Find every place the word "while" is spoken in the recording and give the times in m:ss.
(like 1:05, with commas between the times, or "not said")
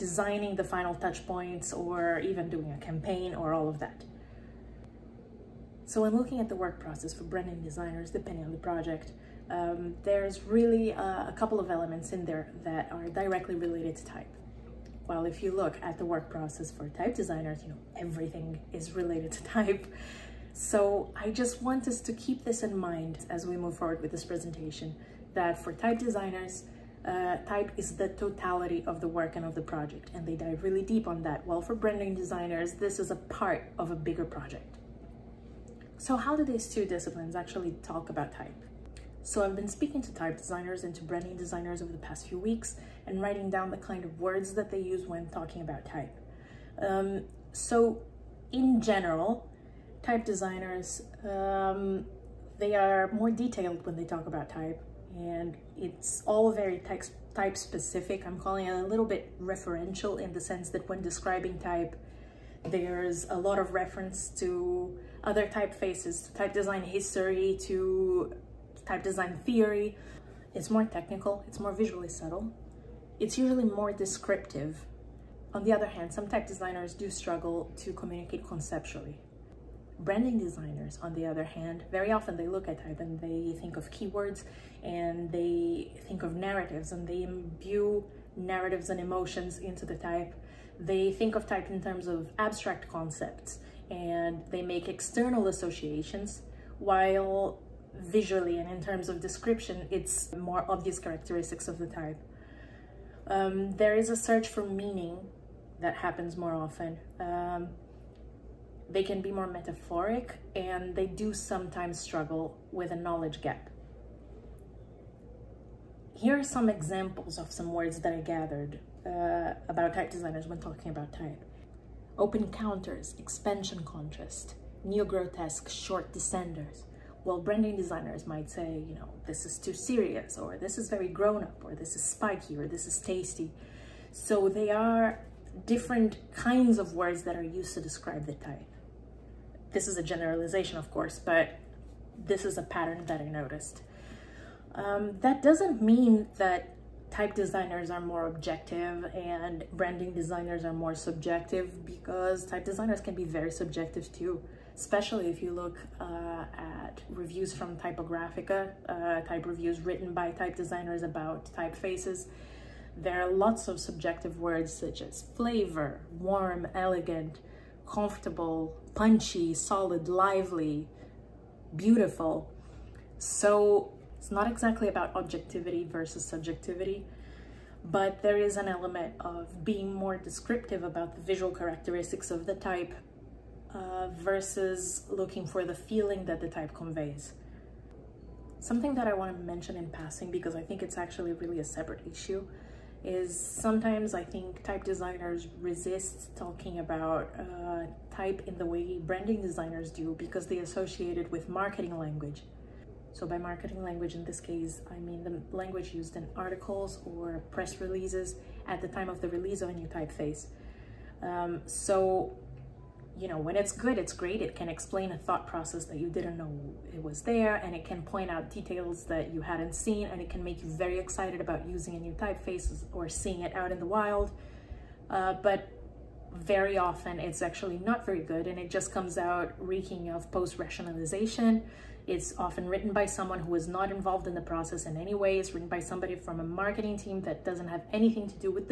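0:31, 1:36.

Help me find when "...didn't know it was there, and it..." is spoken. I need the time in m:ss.
3:36.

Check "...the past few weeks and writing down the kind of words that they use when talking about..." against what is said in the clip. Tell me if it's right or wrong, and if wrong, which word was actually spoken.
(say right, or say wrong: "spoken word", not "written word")
right.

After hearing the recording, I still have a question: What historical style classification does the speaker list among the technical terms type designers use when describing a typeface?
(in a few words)
neo-grotesque.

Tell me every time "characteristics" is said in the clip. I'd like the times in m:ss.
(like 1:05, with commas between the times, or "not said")
1:40, 3:01.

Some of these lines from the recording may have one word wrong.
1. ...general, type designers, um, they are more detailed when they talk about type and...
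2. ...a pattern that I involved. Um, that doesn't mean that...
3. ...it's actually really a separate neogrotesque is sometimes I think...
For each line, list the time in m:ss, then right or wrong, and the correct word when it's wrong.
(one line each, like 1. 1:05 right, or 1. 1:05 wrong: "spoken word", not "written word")
1. 0:48 right
2. 2:22 wrong: "noticed", not "involved"
3. 3:10 wrong: "issue", not "neogrotesque".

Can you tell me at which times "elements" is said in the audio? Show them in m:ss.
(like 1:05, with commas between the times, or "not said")
0:11, 2:58.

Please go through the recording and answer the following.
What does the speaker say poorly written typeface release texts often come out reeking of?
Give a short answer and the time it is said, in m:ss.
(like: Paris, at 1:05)
post-rationalization, at 3:50.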